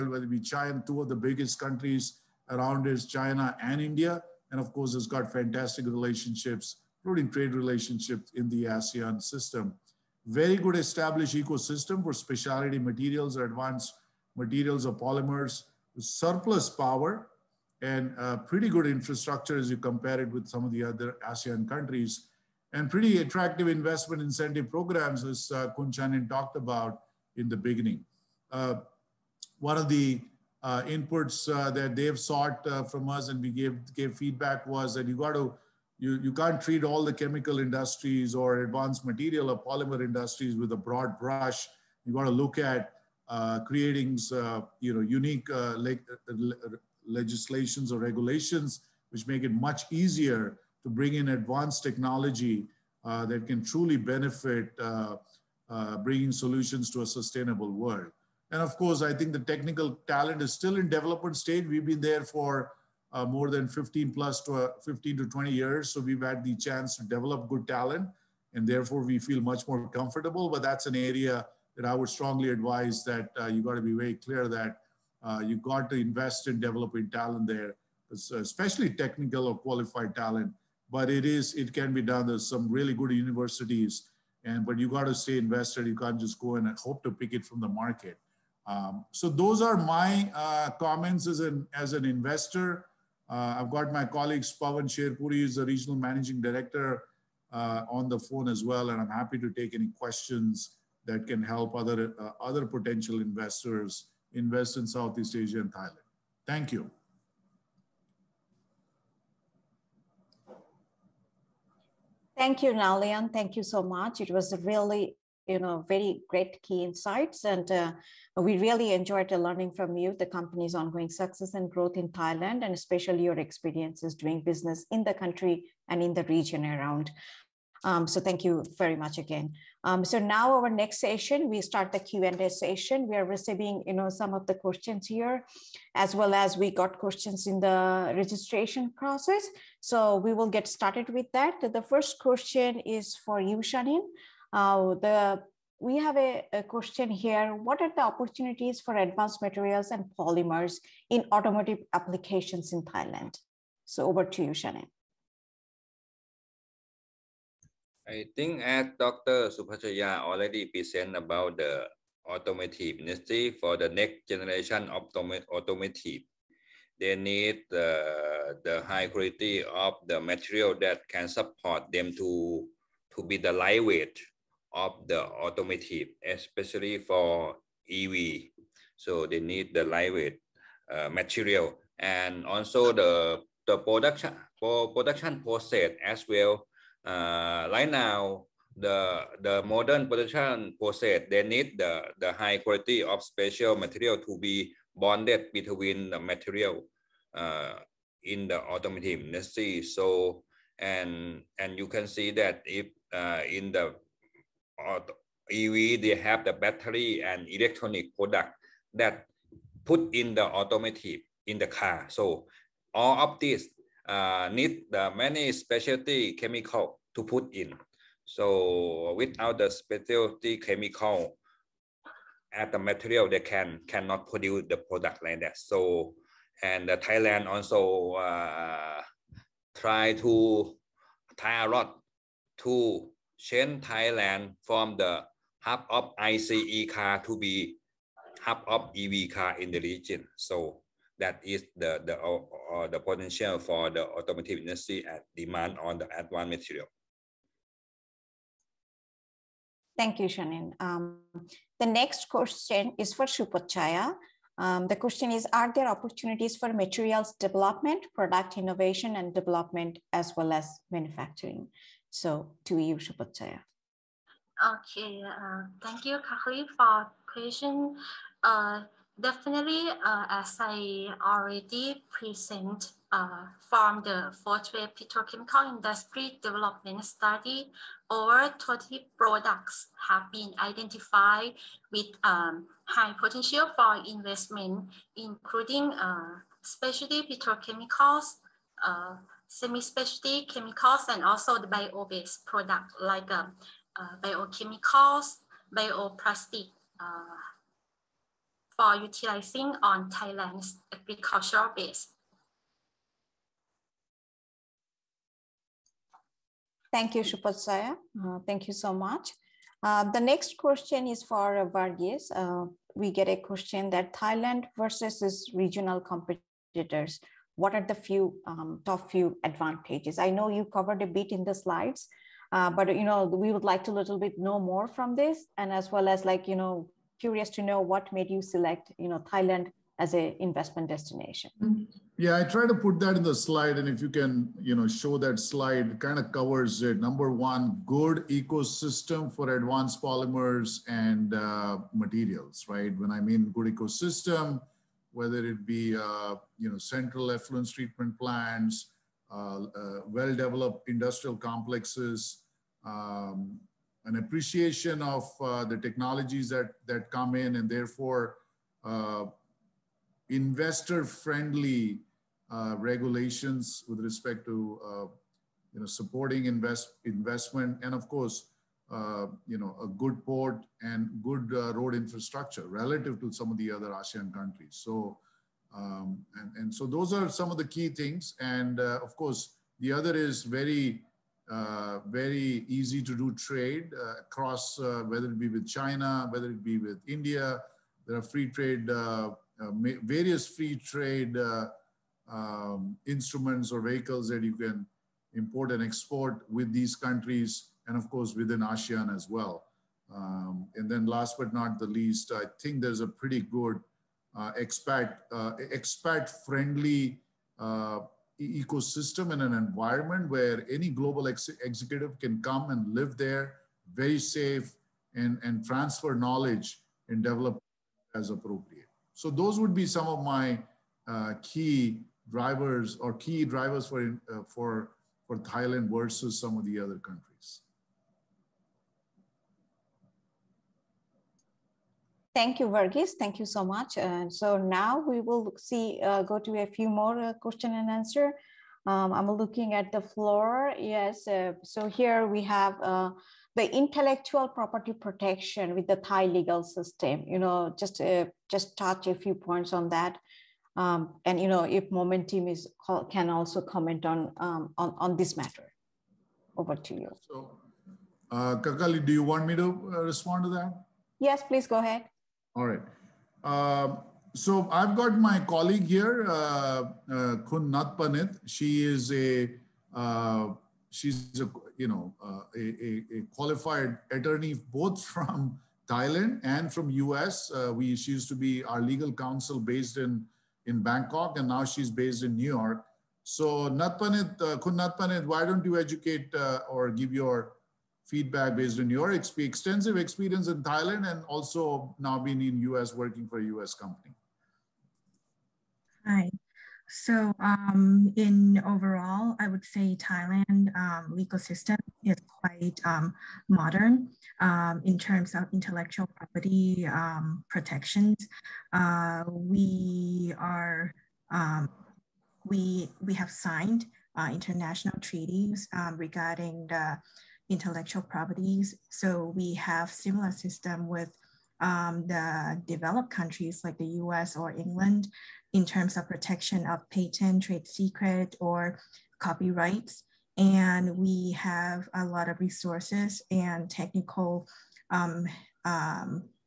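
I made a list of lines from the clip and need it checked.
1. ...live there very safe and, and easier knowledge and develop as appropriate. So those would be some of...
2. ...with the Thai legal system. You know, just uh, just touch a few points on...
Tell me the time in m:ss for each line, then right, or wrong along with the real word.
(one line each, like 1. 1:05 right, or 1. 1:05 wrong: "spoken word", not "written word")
1. 6:52 wrong: "transfer", not "easier"
2. 7:25 right.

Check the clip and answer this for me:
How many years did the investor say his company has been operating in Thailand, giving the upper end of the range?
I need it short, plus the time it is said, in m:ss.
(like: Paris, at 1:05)
15 to 20 years, at 1:04.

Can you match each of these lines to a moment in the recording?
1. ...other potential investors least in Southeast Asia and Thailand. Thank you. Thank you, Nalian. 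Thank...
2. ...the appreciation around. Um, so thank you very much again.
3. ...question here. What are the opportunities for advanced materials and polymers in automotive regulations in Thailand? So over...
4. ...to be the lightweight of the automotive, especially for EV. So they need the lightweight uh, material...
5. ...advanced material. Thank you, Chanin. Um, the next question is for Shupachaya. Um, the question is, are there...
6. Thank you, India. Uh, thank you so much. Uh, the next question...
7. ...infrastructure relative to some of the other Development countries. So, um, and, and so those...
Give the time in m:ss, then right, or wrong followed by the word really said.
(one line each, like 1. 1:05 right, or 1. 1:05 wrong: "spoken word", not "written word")
1. 1:42 wrong: "invest", not "least"
2. 2:06 wrong: "region", not "appreciation"
3. 2:26 wrong: "applications", not "regulations"
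4. 2:53 right
5. 4:06 right
6. 5:06 wrong: "Shupasaya", not "India"
7. 6:11 wrong: "ASEAN", not "Development".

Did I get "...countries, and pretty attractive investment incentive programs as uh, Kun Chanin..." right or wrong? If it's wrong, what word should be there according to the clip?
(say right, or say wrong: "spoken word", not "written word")
right.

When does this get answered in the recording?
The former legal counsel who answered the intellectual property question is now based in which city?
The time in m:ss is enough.
8:02.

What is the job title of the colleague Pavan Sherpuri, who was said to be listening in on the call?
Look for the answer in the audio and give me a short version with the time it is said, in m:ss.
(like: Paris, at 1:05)
regional managing director, at 1:35.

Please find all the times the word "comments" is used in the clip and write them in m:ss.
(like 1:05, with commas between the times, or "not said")
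1:30, 7:33.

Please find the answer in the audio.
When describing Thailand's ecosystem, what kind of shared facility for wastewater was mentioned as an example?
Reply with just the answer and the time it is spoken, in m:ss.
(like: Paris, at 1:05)
central effluent treatment plants, at 5:46.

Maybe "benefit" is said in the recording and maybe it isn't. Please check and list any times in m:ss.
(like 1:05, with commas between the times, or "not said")
0:53.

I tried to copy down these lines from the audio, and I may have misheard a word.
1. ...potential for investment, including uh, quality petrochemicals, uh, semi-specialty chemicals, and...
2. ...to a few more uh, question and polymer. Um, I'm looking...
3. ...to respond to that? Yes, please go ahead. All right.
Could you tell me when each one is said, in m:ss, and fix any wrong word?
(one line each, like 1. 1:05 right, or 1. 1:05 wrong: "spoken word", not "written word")
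1. 4:43 wrong: "specialty", not "quality"
2. 7:16 wrong: "answer", not "polymer"
3. 7:39 right.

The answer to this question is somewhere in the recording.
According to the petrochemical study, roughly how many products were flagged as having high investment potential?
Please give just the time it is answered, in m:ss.
4:38.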